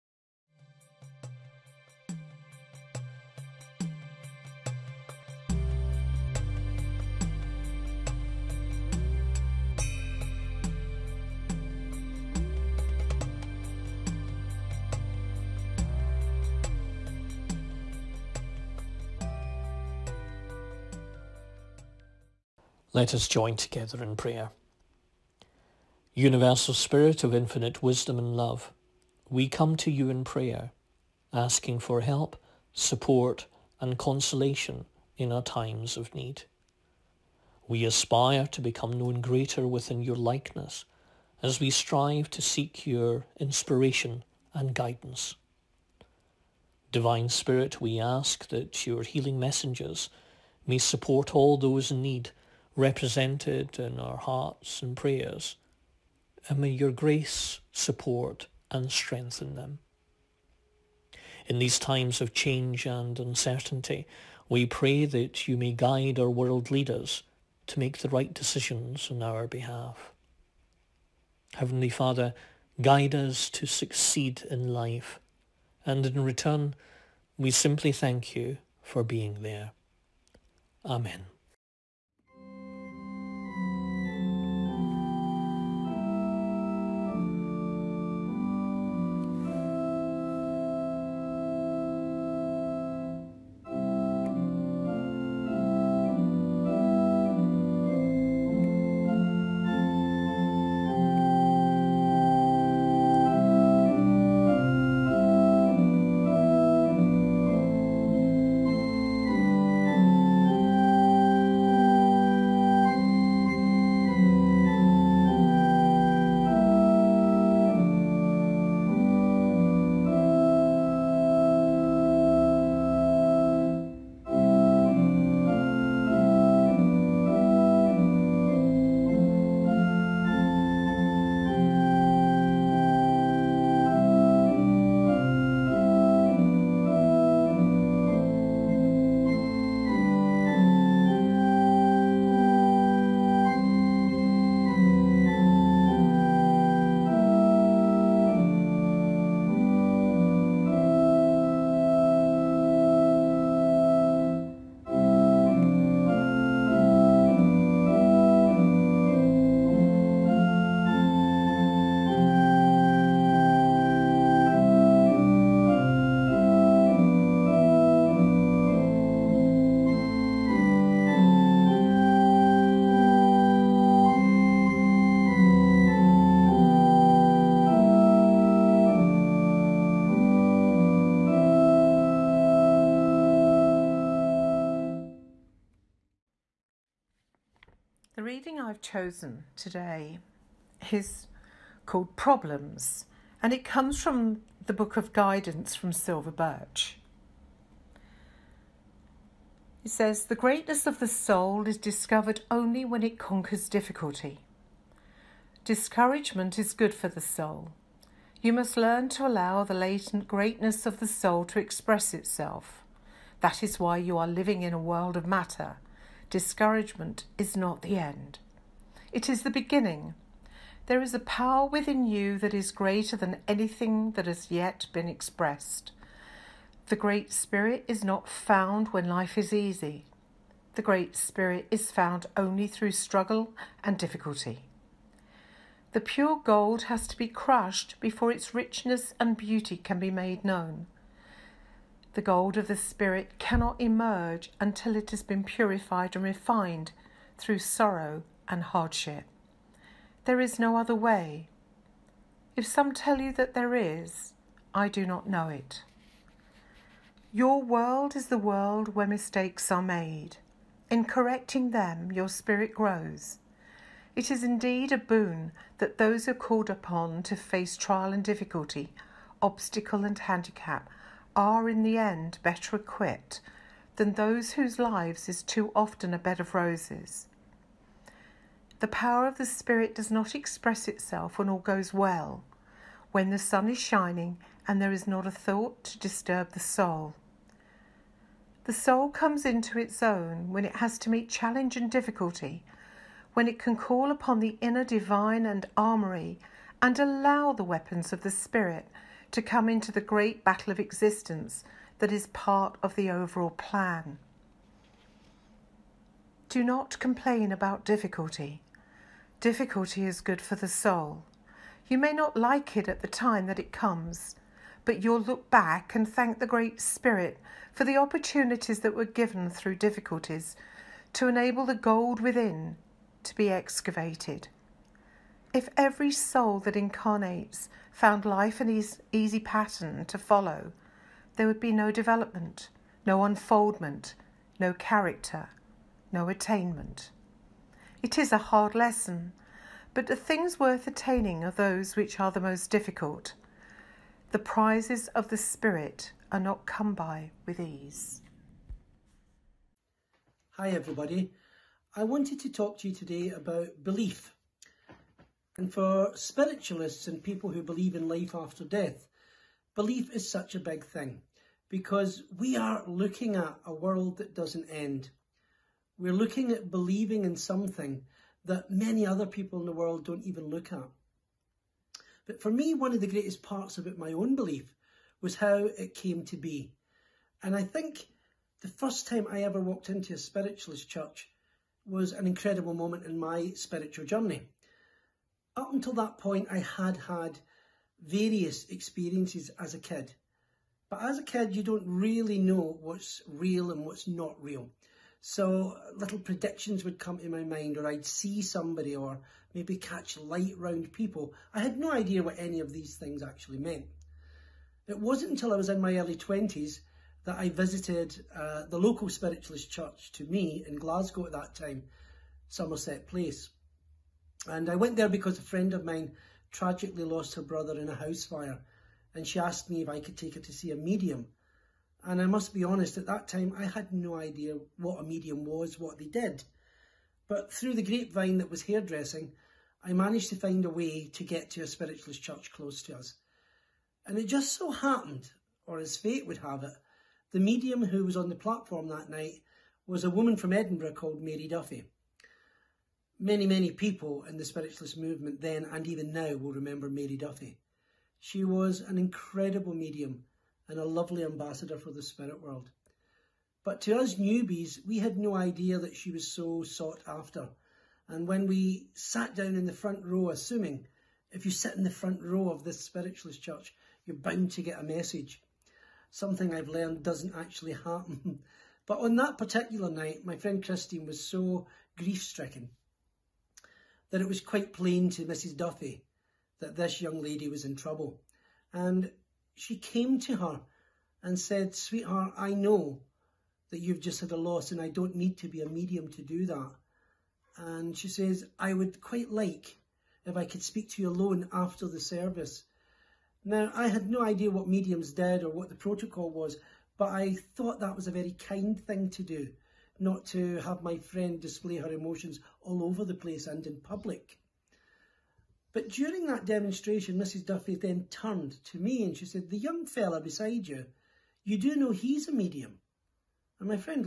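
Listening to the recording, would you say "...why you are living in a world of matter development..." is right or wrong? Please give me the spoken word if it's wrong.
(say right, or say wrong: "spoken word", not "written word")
wrong: "discouragement", not "development".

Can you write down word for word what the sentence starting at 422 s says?
And I must be honest, at that time I had no idea what a medium was, what they did.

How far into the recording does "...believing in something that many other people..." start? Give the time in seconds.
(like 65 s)
366 s.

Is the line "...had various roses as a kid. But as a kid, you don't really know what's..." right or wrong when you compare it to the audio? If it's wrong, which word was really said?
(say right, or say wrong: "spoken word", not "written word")
wrong: "experiences", not "roses".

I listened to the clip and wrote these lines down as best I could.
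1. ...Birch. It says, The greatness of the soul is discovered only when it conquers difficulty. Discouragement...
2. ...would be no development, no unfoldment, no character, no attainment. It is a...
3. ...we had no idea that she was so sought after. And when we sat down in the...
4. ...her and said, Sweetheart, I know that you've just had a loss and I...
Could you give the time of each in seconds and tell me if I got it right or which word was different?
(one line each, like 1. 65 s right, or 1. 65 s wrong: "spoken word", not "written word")
1. 196 s right
2. 331 s right
3. 454 s right
4. 480 s right.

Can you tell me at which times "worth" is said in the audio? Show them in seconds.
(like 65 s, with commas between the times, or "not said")
340 s.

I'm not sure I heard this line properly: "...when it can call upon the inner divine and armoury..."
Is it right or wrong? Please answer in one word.
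right.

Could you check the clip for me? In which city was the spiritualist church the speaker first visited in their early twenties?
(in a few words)
Glasgow.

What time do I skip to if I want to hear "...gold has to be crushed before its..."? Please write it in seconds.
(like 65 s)
236 s.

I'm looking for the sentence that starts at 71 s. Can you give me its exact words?
Heavenly Father, guide us to succeed in life, and in return, we simply thank you for being there.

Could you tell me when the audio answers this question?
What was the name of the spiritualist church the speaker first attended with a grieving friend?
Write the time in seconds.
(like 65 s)
412 s.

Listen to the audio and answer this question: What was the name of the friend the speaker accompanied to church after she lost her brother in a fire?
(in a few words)
Christine.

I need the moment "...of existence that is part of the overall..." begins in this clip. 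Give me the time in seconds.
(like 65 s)
300 s.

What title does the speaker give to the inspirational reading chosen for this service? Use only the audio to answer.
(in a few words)
Problems.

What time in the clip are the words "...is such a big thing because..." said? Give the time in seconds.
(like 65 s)
360 s.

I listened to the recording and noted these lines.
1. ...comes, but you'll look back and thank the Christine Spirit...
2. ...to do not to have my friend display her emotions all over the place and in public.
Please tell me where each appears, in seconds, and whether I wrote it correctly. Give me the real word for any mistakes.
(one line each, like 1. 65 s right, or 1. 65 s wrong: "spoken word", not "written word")
1. 313 s wrong: "Great", not "Christine"
2. 499 s right.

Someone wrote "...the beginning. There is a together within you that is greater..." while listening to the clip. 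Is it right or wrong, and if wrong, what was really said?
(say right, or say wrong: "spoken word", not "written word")
wrong: "power", not "together".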